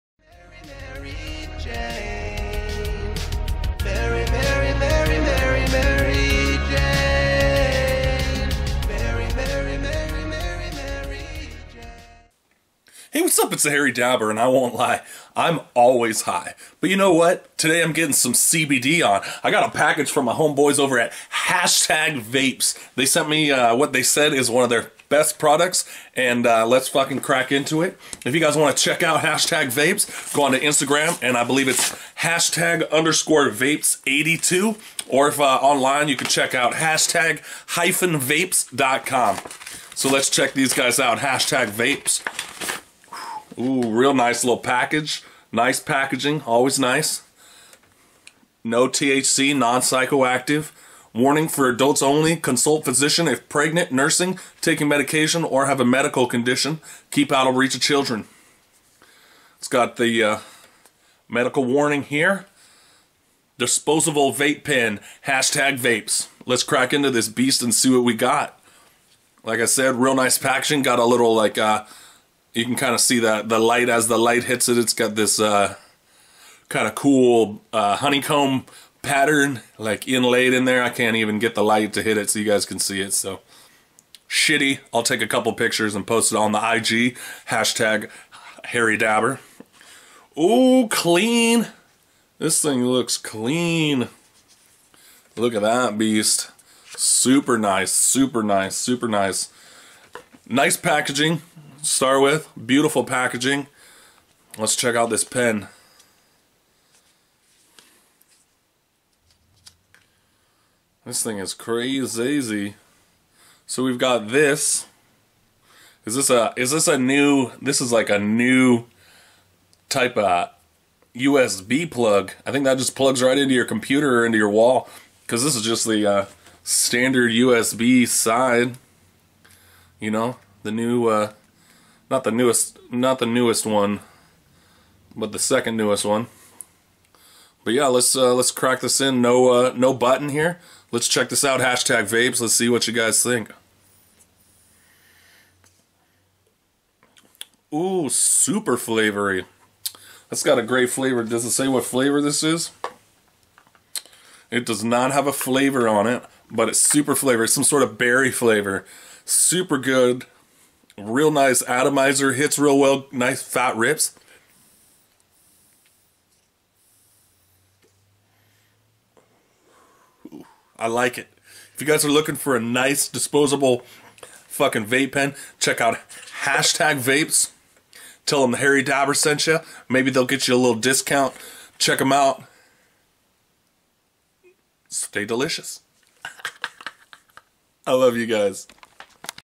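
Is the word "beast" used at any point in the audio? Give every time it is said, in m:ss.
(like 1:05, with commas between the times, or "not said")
1:07, 1:35.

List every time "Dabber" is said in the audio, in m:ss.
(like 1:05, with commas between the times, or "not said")
0:13, 1:28, 2:58.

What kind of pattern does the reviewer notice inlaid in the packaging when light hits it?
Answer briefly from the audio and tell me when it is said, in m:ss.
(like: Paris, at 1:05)
Honeycomb, at 1:17.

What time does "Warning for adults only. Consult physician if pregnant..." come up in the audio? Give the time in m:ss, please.
0:51.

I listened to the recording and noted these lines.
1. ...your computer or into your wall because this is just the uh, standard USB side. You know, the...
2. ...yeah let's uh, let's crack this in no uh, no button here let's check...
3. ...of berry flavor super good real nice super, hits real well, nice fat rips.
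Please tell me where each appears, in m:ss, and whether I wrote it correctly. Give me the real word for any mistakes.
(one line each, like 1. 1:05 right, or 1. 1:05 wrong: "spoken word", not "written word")
1. 2:03 right
2. 2:17 right
3. 2:37 wrong: "atomizer", not "super".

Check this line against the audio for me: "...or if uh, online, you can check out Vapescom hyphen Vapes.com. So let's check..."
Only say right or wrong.
wrong.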